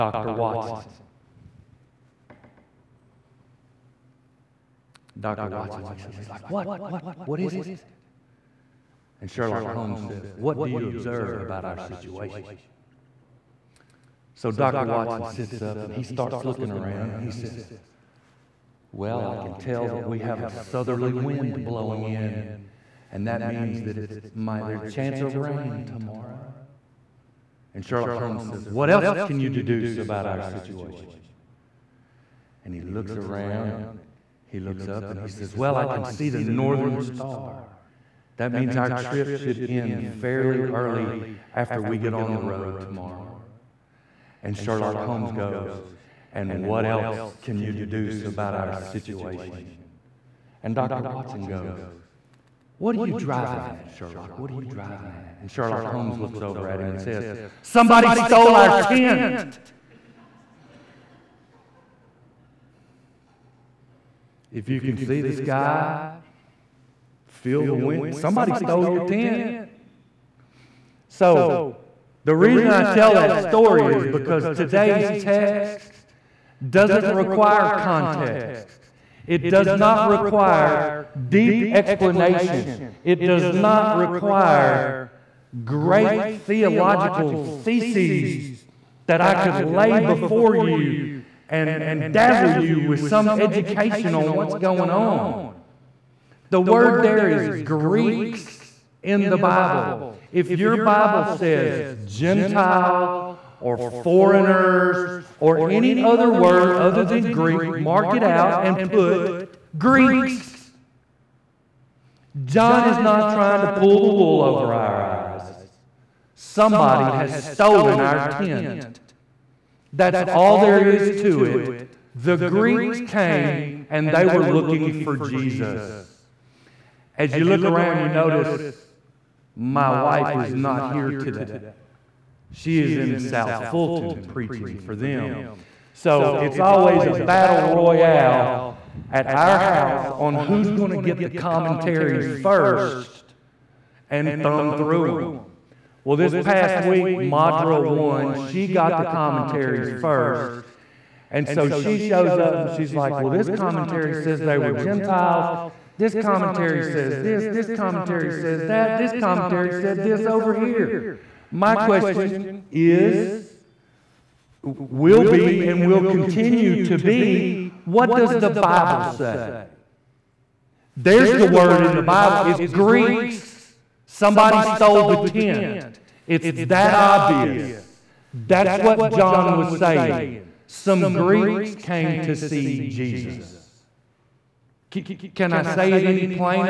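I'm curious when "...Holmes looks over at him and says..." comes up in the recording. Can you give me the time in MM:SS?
00:55.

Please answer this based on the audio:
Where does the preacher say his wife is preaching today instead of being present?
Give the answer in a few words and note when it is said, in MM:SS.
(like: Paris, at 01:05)
South Fulton, at 02:13.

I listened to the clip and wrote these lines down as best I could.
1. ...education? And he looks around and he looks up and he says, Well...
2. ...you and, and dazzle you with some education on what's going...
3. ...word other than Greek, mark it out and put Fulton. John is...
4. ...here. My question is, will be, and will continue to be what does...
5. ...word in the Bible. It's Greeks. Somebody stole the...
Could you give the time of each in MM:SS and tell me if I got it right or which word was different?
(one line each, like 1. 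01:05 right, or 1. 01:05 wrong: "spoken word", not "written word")
1. 00:30 wrong: "situation", not "education"
2. 01:30 right
3. 01:46 wrong: "Greeks", not "Fulton"
4. 02:40 right
5. 02:51 right.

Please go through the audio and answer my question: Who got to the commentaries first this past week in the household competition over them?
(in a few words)
Madra.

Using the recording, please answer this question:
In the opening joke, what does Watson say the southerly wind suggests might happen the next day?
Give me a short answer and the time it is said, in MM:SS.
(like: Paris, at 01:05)
Rain, at 00:25.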